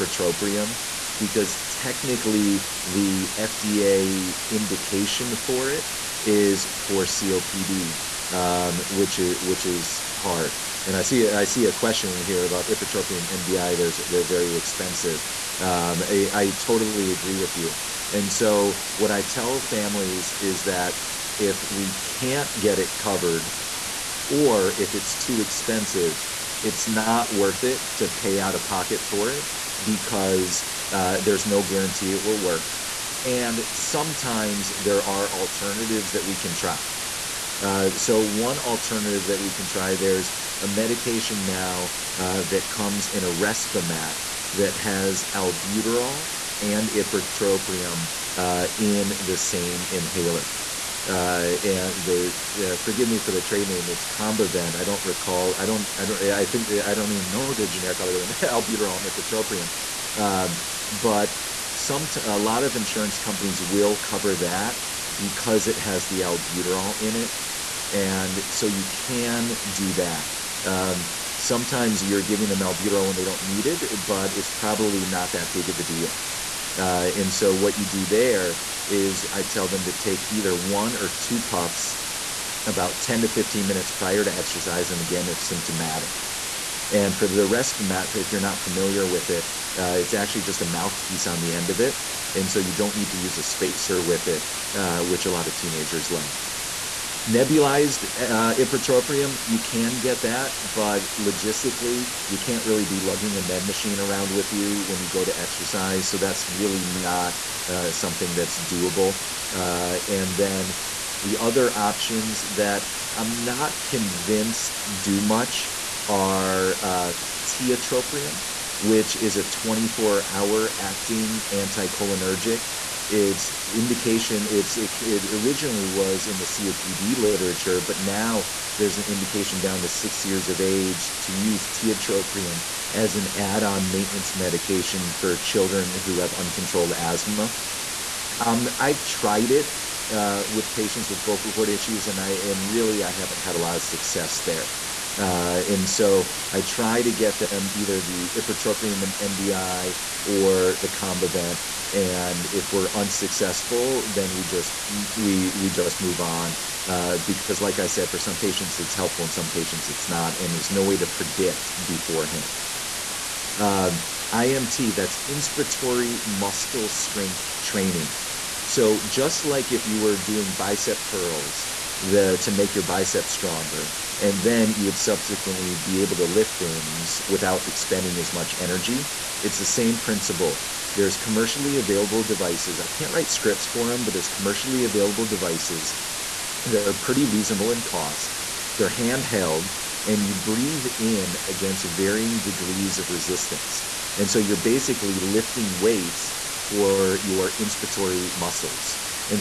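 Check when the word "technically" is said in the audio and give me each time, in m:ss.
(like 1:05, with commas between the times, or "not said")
0:01.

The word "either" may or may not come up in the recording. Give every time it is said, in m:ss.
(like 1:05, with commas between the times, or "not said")
1:20, 2:27.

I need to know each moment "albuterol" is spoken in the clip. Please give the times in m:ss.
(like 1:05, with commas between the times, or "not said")
0:45, 0:58, 1:06, 1:12.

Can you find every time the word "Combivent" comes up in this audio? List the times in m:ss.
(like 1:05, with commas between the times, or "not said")
0:54, 2:30.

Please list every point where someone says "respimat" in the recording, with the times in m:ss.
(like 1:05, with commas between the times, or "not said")
0:43, 1:27.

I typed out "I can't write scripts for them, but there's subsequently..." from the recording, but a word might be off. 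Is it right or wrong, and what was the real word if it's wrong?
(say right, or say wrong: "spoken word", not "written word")
wrong: "commercially", not "subsequently".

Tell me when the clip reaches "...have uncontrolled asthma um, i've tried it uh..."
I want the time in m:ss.
2:16.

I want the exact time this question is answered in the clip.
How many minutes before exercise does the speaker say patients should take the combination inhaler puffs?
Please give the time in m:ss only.
1:23.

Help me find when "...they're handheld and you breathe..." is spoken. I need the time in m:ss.
3:08.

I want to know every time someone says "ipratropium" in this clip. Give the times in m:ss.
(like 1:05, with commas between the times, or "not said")
0:12, 0:46, 0:59, 1:38, 2:28.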